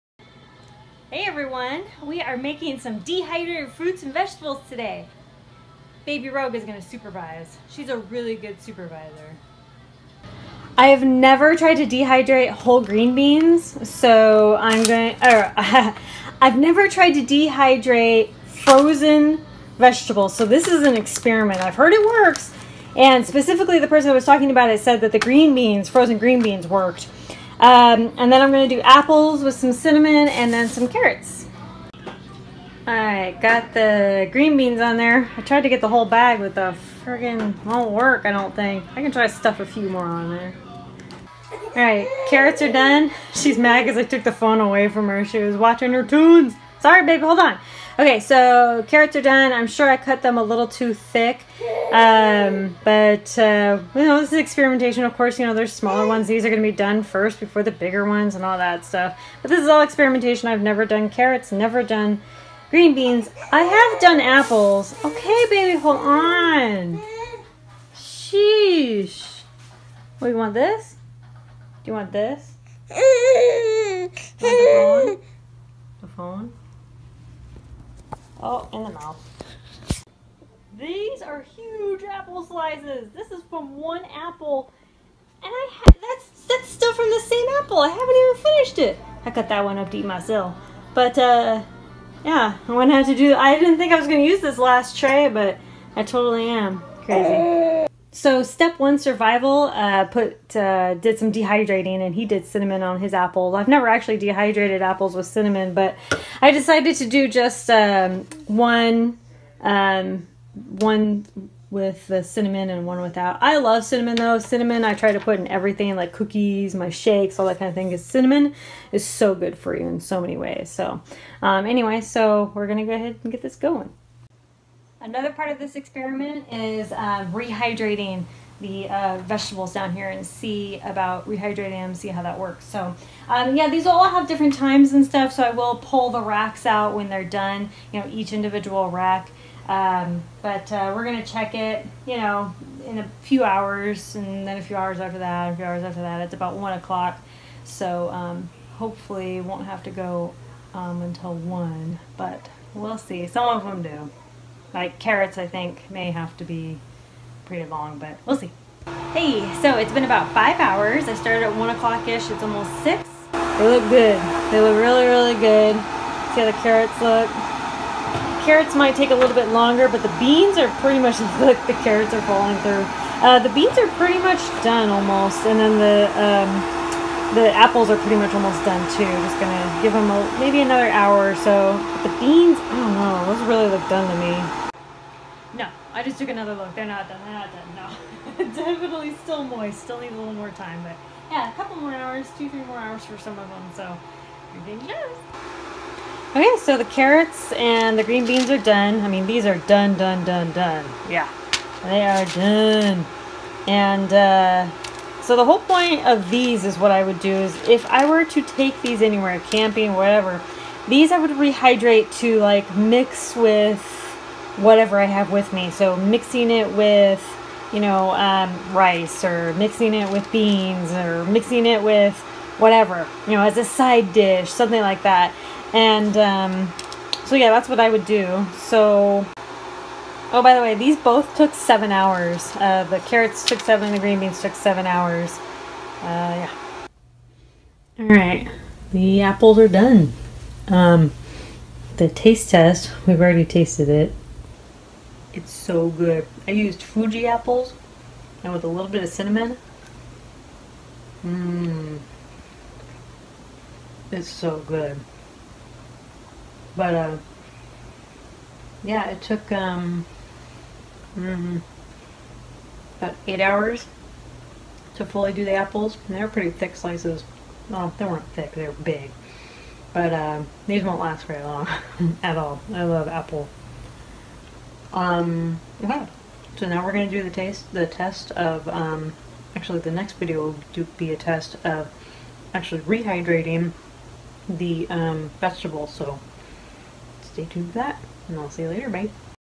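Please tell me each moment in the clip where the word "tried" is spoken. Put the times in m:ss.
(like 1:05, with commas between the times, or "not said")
0:11, 0:16, 0:35.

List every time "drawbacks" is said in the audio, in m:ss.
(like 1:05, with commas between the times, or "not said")
not said.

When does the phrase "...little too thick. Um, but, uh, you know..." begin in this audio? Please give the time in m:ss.
0:50.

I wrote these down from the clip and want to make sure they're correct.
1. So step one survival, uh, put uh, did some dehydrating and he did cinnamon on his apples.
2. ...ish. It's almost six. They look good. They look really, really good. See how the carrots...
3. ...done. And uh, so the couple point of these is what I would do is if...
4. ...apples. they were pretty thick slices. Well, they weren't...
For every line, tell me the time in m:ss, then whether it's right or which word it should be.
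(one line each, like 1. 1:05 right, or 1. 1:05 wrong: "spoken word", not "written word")
1. 1:38 right
2. 2:42 right
3. 3:22 wrong: "whole", not "couple"
4. 4:25 right.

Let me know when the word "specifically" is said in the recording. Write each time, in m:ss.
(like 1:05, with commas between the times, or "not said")
0:23.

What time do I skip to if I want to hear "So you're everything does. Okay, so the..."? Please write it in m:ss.
3:13.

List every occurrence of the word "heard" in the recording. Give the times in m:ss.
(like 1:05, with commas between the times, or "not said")
0:21.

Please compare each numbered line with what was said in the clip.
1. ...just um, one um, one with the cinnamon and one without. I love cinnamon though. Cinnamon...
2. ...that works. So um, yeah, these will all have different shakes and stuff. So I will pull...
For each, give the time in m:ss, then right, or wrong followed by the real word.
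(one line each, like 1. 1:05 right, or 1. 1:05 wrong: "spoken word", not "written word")
1. 1:47 right
2. 2:12 wrong: "times", not "shakes".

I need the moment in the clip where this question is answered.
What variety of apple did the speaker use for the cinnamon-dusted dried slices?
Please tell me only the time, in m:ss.
4:06.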